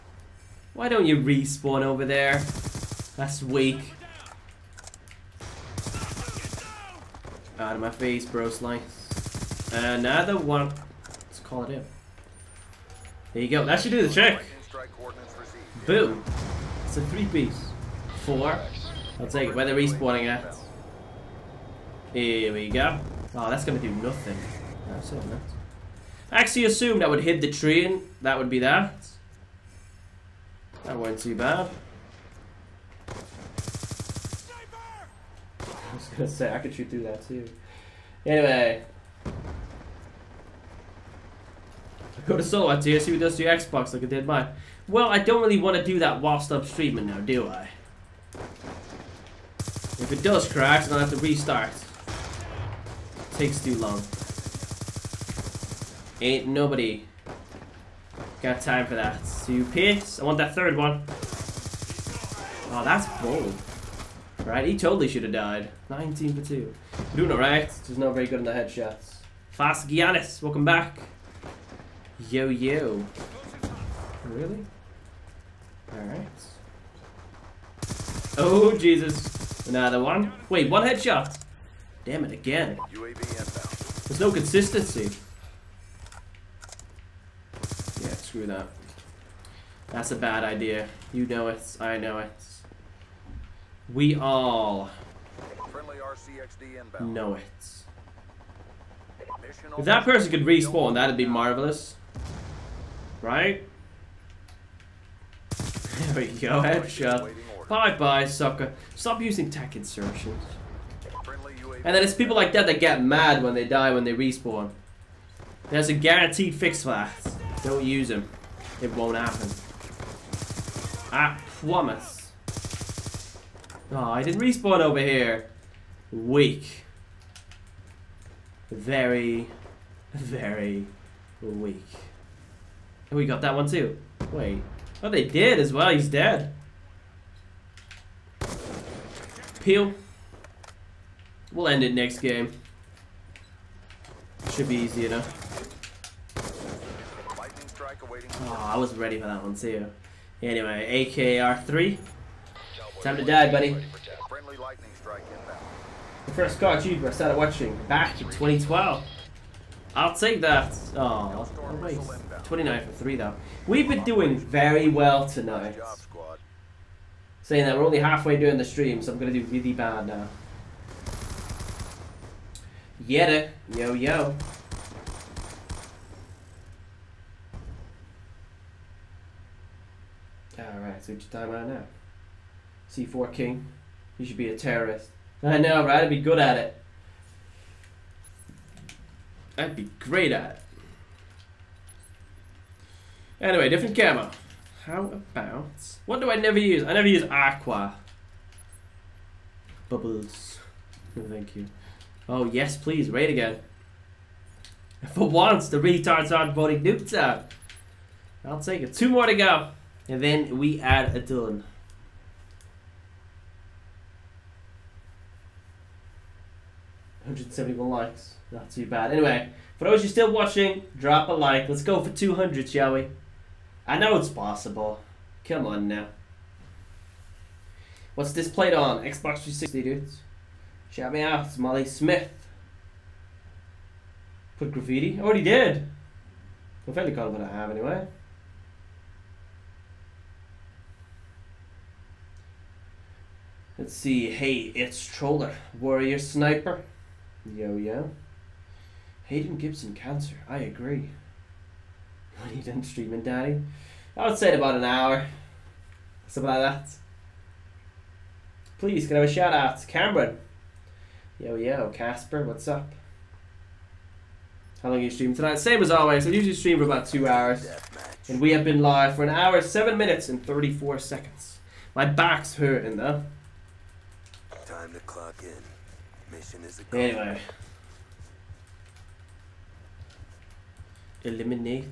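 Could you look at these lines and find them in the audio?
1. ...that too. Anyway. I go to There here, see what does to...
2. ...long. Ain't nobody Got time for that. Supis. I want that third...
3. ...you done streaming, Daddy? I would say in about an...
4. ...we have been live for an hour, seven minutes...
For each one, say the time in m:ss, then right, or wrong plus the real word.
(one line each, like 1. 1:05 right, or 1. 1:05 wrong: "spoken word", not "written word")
1. 0:37 wrong: "Silhouette", not "There"
2. 0:53 right
3. 4:12 right
4. 4:28 right.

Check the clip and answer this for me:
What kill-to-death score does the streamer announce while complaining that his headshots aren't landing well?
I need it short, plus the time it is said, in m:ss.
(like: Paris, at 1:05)
19 for 2, at 1:05.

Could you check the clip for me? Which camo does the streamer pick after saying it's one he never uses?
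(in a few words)
Aqua.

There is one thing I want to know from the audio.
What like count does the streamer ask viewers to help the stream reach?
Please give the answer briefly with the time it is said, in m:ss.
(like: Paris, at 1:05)
200, at 3:42.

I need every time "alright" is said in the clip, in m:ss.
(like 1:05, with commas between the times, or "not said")
1:07, 1:15.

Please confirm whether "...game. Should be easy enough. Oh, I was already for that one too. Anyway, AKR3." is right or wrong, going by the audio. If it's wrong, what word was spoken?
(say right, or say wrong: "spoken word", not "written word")
wrong: "ready", not "already".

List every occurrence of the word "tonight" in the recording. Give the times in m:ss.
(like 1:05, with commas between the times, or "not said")
2:45, 4:25.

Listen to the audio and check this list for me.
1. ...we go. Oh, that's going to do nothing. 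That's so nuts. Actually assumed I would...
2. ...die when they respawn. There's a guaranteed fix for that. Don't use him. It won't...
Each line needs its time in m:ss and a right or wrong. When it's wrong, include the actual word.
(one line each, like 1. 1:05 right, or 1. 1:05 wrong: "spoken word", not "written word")
1. 0:22 right
2. 1:53 right.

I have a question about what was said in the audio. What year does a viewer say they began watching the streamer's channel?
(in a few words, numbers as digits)
2012.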